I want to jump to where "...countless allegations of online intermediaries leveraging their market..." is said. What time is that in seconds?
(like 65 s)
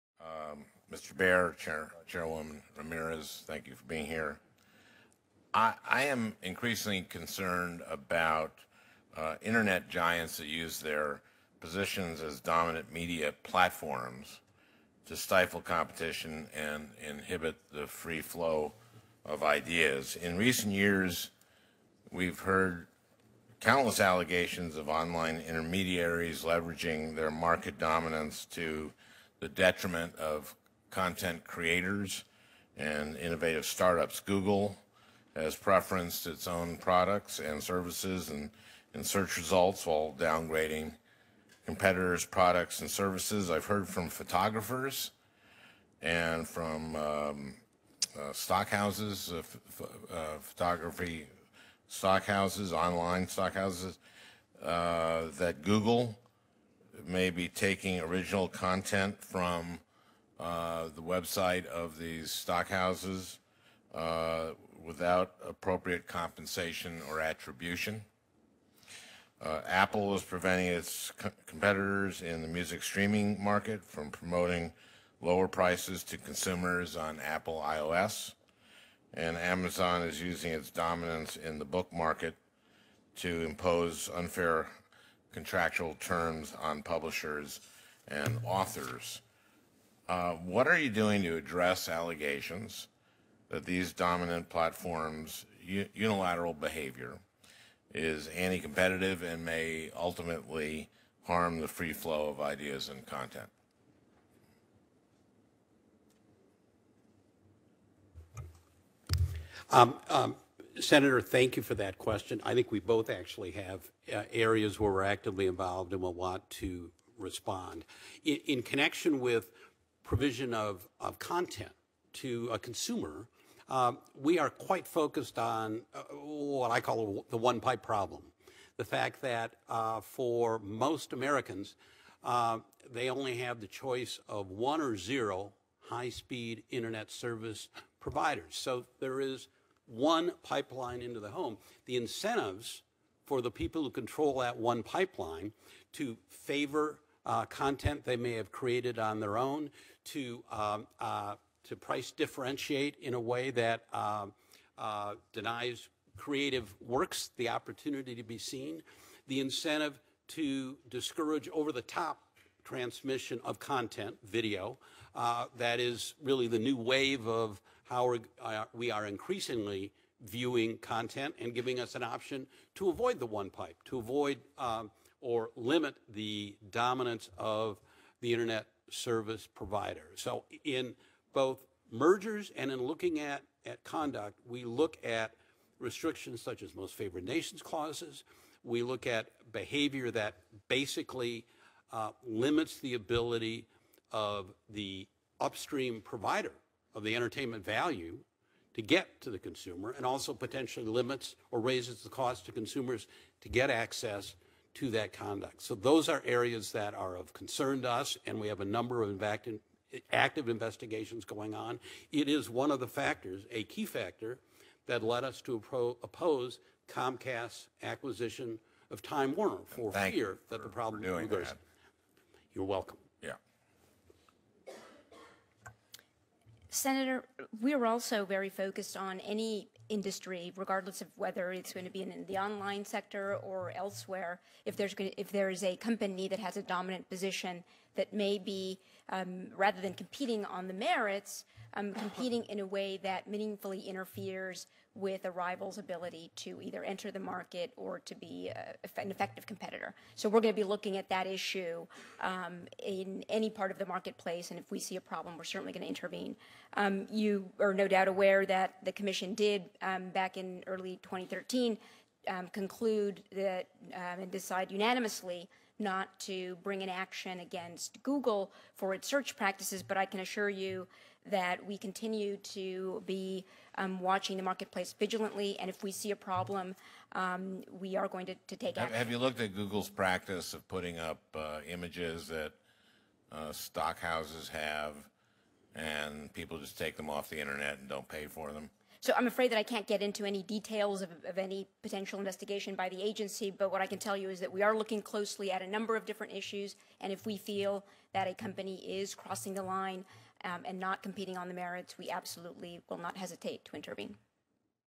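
23 s.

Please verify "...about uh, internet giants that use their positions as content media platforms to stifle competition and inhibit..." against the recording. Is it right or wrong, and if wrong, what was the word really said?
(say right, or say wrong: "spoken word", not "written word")
wrong: "dominant", not "content".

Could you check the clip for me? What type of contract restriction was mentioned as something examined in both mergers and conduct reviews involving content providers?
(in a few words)
most favored nations clauses.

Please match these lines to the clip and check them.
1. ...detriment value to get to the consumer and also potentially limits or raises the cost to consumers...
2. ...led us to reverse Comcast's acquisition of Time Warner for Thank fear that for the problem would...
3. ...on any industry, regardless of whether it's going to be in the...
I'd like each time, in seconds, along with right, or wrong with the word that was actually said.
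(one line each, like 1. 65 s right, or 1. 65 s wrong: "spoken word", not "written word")
1. 197 s wrong: "entertainment", not "detriment"
2. 215 s wrong: "oppose", not "reverse"
3. 228 s right.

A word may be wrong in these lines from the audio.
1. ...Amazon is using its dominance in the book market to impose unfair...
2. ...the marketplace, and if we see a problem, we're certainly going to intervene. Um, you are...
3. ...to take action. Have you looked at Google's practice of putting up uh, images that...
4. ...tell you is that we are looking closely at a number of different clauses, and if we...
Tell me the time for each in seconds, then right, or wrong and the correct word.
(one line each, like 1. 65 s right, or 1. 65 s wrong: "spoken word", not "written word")
1. 79 s right
2. 253 s right
3. 278 s right
4. 293 s wrong: "issues", not "clauses".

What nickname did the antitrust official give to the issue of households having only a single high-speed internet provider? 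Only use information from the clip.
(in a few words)
the one pipe problem.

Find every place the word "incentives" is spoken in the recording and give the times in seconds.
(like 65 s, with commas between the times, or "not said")
141 s, 159 s.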